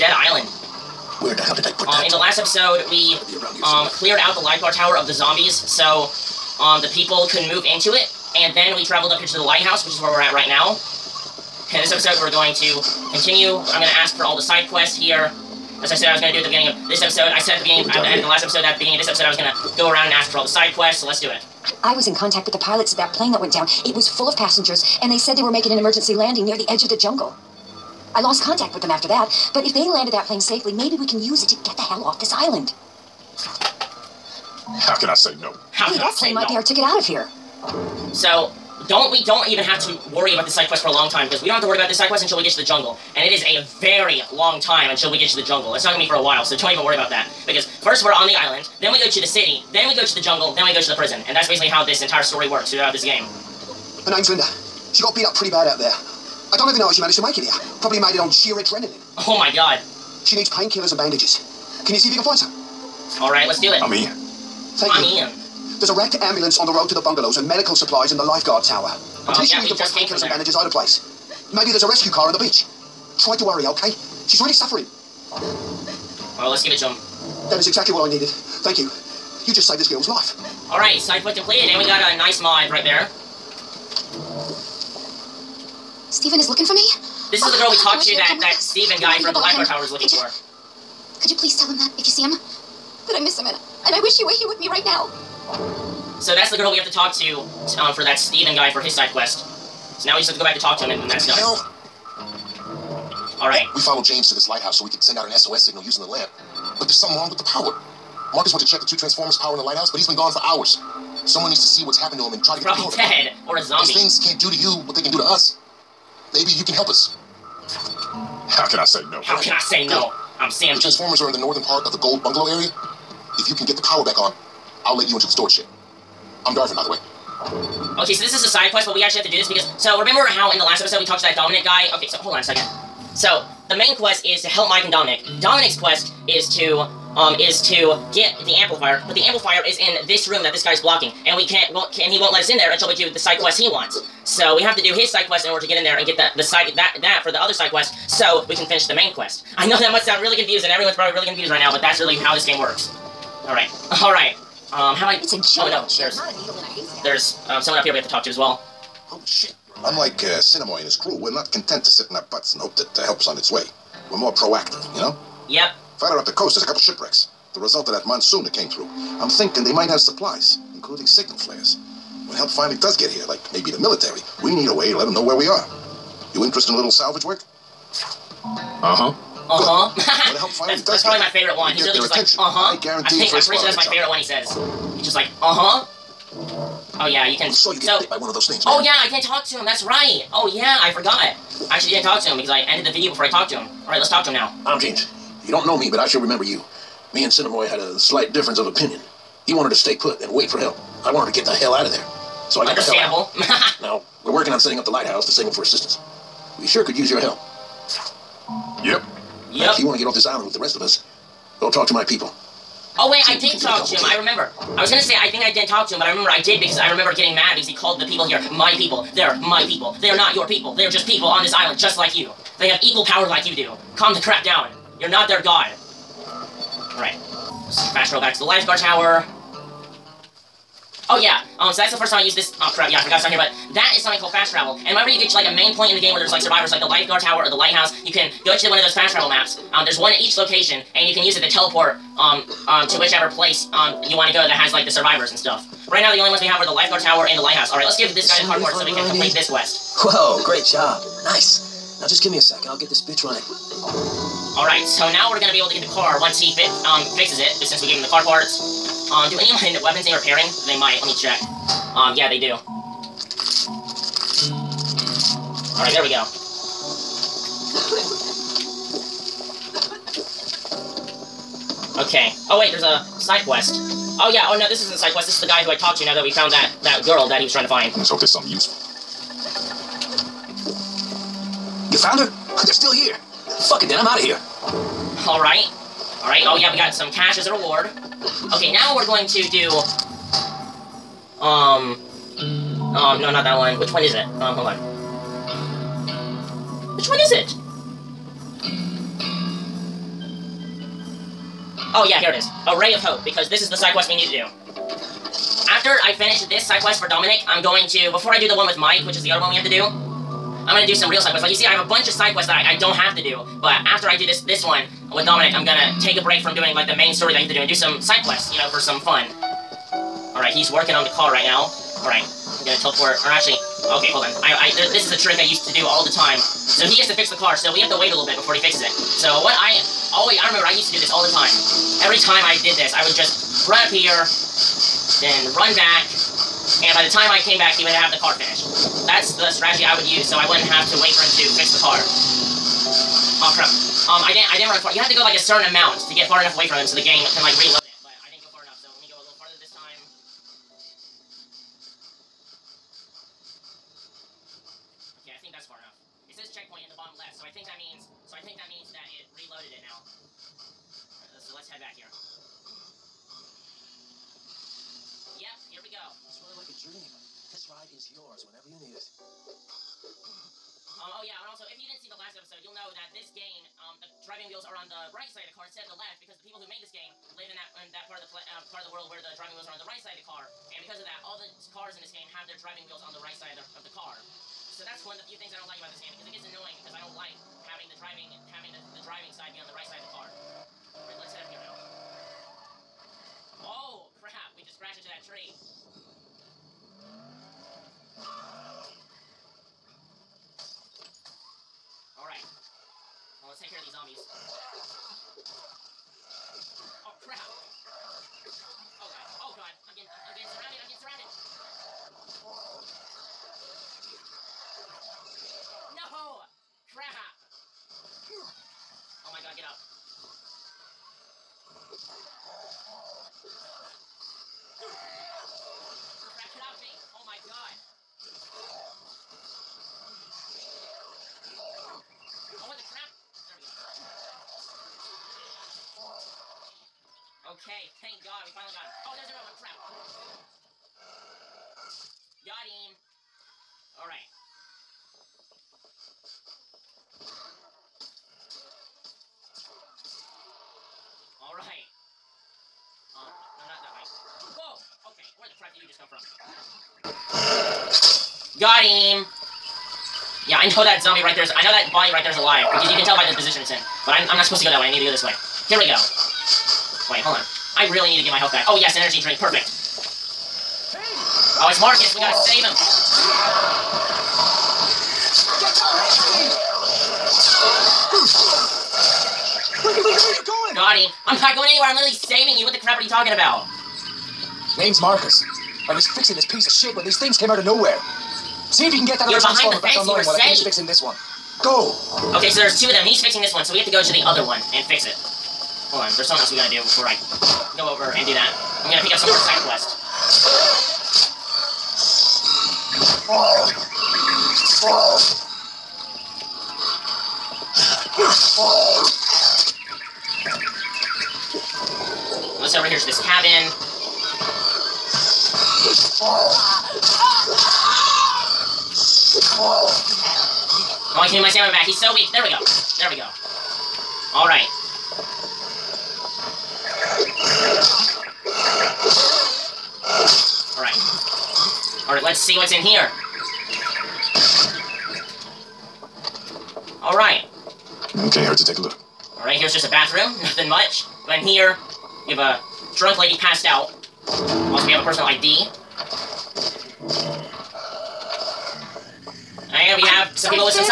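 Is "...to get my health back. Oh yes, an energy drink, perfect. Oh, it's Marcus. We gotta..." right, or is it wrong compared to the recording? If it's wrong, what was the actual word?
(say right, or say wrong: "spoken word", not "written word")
right.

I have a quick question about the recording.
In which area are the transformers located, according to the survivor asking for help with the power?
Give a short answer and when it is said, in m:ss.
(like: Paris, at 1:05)
Gold Bungalow area, at 2:01.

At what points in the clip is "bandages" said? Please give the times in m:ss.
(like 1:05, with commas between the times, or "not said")
1:00, 1:10.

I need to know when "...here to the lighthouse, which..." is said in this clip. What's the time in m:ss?
0:09.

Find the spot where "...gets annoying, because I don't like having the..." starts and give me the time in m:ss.
6:26.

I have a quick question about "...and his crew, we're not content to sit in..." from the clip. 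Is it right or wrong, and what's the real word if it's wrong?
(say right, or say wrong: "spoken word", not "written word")
right.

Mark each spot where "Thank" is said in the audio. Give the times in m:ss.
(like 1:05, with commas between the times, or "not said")
1:04, 1:18.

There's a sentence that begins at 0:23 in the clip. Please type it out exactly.
It was full of passengers, and they said they were making an emergency landing near the edge of the jungle.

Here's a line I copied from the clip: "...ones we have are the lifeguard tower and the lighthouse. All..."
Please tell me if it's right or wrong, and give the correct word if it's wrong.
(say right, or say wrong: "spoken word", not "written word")
right.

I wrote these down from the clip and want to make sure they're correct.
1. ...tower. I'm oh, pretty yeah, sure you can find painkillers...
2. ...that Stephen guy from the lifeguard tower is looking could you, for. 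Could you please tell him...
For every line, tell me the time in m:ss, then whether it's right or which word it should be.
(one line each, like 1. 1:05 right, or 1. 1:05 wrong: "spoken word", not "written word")
1. 1:08 right
2. 1:28 right.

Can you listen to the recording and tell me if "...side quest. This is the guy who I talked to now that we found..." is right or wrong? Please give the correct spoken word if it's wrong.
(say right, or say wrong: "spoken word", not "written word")
right.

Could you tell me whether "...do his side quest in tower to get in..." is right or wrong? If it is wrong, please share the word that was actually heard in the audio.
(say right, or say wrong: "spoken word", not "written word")
wrong: "order", not "tower".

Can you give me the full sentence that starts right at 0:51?
And that's basically how this entire story works throughout this game.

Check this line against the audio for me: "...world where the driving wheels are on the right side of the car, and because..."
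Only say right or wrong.
right.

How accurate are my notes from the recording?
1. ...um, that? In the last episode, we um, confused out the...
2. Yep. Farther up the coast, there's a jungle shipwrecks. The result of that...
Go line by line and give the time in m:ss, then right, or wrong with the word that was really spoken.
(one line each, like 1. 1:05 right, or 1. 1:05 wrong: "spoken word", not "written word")
1. 0:01 wrong: "cleared", not "confused"
2. 2:45 wrong: "couple", not "jungle".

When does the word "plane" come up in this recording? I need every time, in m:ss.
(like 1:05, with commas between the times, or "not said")
0:23, 0:30, 0:36.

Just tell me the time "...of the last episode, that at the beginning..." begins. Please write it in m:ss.
0:18.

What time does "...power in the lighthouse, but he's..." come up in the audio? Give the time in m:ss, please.
1:49.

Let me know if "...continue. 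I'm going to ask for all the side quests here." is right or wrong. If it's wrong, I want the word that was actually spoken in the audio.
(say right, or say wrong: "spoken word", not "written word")
right.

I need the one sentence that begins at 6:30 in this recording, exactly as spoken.
Alright, let's head up here now.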